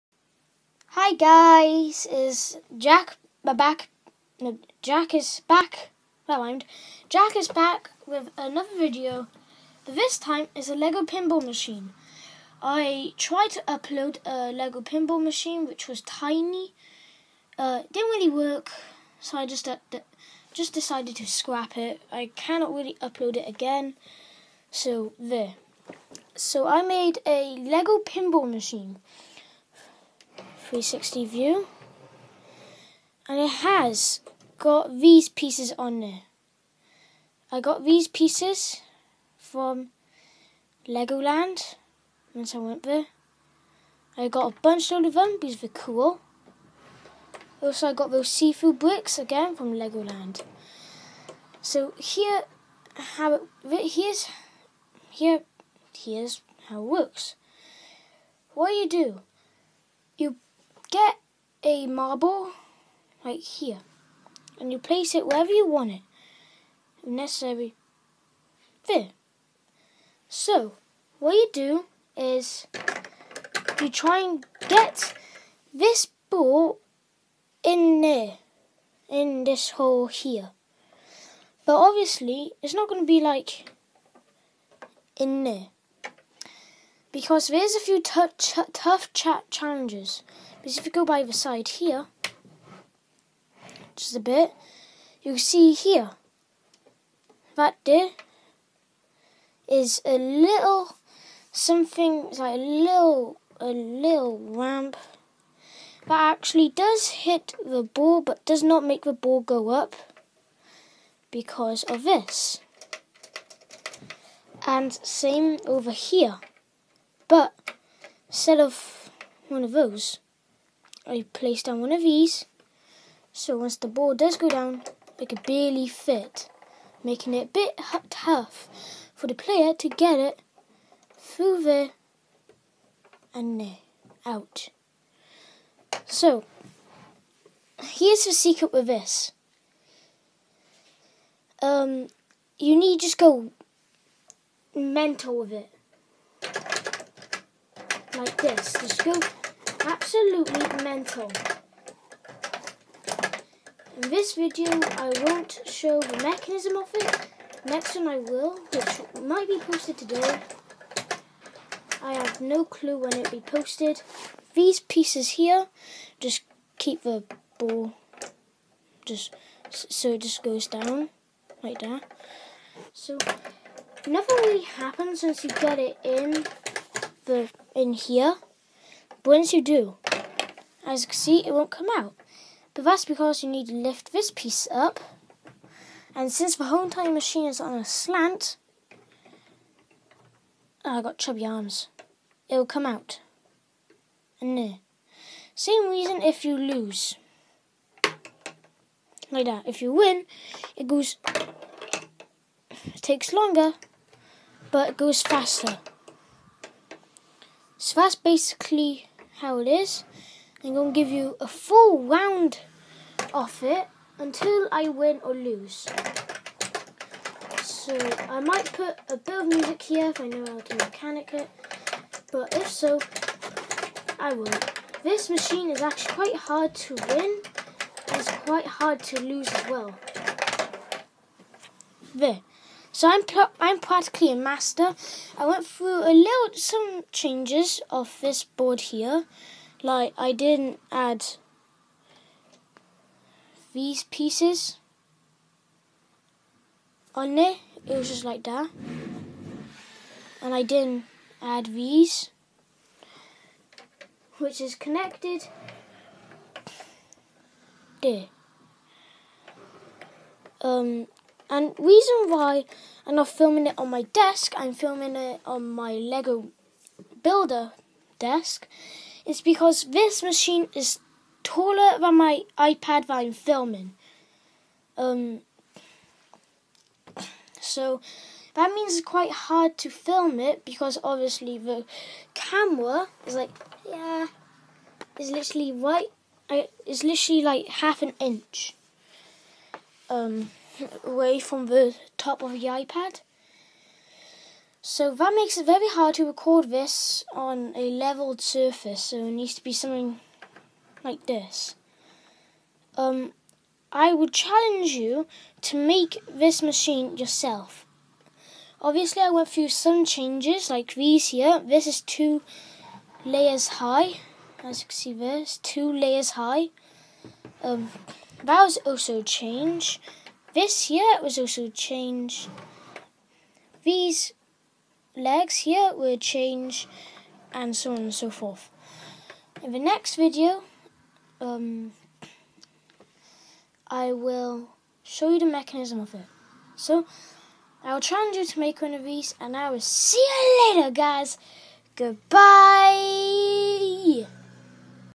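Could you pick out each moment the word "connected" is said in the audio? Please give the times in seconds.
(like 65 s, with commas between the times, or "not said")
254 s.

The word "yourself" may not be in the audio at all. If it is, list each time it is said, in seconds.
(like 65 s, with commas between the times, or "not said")
307 s.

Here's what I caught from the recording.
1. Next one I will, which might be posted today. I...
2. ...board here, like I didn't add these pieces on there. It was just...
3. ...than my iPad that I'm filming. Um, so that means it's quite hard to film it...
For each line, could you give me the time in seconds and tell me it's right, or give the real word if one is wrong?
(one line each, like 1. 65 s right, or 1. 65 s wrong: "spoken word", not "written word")
1. 157 s right
2. 238 s right
3. 271 s right.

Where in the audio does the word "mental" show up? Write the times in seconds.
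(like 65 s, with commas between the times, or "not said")
144 s, 150 s.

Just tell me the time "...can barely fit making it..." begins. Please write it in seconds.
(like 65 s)
125 s.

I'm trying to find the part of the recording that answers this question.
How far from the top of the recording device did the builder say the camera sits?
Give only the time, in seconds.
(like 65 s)
287 s.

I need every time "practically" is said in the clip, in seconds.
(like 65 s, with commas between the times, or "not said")
233 s.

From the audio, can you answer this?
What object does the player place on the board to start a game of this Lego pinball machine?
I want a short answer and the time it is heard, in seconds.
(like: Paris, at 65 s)
a marble, at 61 s.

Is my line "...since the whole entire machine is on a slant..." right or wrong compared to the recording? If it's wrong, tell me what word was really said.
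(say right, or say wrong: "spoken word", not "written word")
right.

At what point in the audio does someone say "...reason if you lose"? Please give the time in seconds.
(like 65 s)
195 s.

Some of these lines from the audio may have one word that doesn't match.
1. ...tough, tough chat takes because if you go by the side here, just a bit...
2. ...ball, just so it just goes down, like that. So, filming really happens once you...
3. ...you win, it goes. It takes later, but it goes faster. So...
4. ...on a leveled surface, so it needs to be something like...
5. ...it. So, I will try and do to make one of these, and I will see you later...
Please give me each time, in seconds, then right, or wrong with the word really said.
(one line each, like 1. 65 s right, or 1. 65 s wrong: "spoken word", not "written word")
1. 88 s wrong: "challenges", not "takes"
2. 167 s wrong: "nothing", not "filming"
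3. 199 s wrong: "longer", not "later"
4. 297 s right
5. 336 s right.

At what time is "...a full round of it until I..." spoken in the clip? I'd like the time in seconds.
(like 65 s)
211 s.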